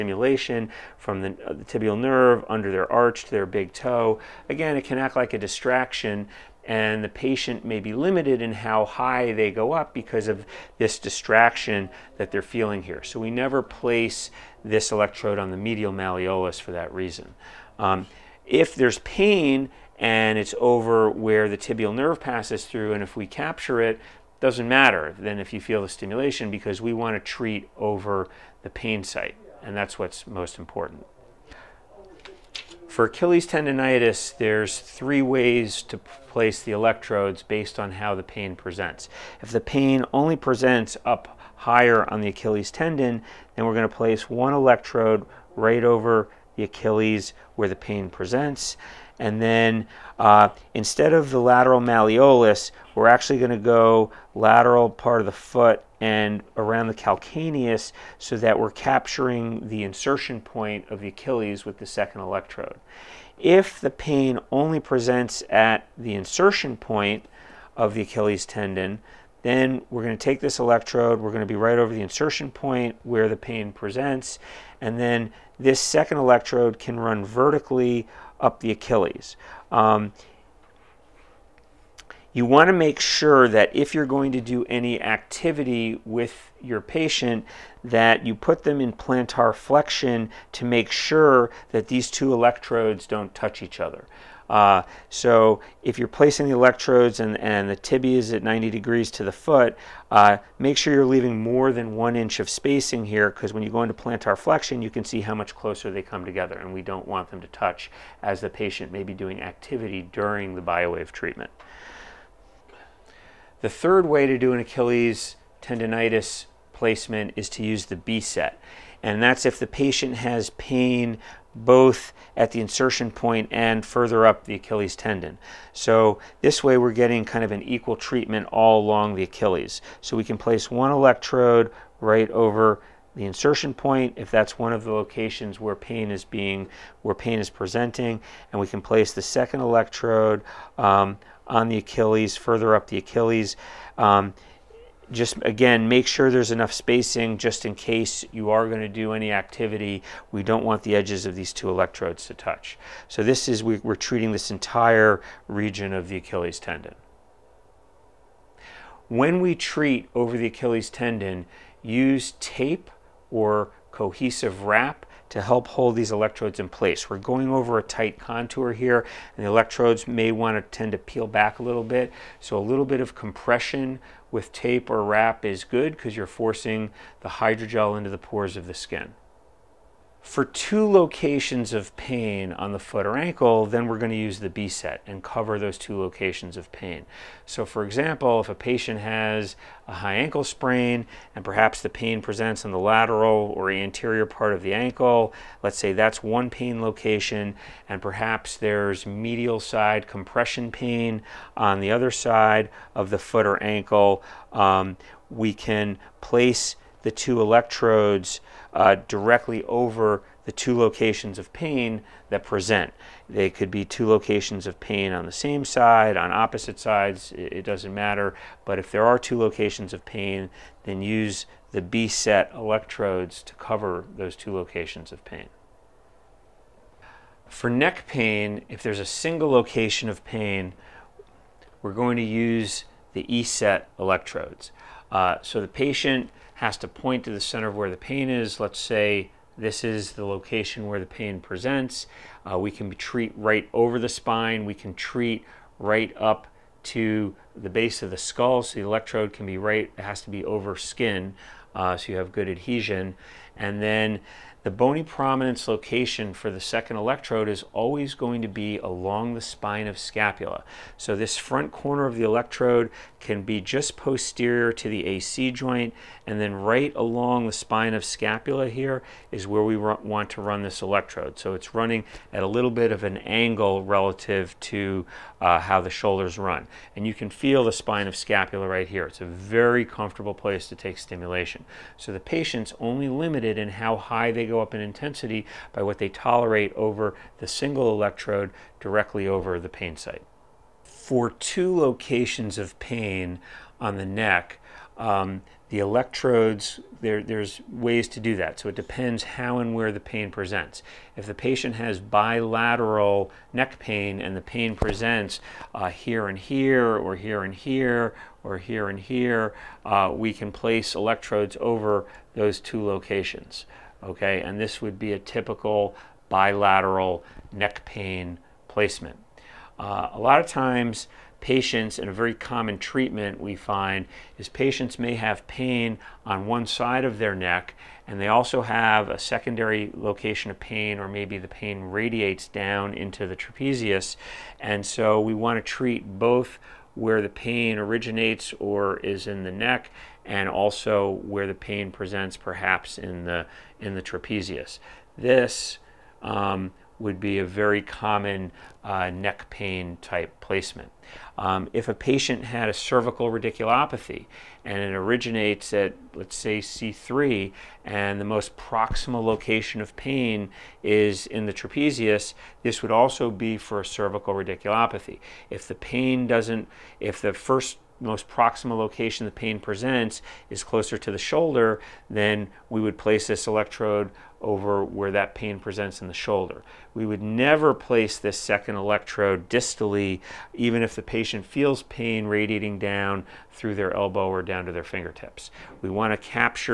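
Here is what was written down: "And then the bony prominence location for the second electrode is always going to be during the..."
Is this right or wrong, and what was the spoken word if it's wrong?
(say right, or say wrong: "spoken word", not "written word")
wrong: "along", not "during".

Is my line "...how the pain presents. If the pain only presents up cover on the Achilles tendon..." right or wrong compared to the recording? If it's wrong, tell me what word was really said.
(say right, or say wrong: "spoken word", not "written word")
wrong: "higher", not "cover".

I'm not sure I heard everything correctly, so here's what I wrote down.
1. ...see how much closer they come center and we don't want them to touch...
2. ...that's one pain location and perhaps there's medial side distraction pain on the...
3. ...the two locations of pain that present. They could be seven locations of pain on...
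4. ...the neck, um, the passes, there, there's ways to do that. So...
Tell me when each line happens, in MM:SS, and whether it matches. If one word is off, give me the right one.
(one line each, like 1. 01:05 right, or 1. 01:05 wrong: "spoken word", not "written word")
1. 01:45 wrong: "together", not "center"
2. 03:15 wrong: "compression", not "distraction"
3. 03:30 wrong: "two", not "seven"
4. 04:53 wrong: "electrodes", not "passes".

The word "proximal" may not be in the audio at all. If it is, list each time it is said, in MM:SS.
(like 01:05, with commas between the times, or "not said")
05:58, 06:08.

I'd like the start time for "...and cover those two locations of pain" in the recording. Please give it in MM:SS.
03:05.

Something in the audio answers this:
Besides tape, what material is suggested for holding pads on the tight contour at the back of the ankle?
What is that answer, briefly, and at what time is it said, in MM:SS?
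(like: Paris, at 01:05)
cohesive wrap, at 02:43.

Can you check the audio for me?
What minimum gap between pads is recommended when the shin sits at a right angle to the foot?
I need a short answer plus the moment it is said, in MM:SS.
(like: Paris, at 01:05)
more than one inch, at 01:41.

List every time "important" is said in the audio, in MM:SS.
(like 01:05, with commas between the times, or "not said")
00:30.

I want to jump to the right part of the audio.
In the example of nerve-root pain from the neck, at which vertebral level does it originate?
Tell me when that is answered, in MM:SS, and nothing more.
05:56.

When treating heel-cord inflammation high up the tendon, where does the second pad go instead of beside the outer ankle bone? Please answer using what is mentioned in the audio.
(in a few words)
lateral part of the foot.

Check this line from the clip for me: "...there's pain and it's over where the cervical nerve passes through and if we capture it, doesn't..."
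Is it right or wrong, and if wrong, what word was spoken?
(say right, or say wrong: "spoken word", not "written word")
wrong: "tibial", not "cervical".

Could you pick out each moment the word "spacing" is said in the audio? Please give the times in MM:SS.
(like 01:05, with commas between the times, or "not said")
01:42, 02:26.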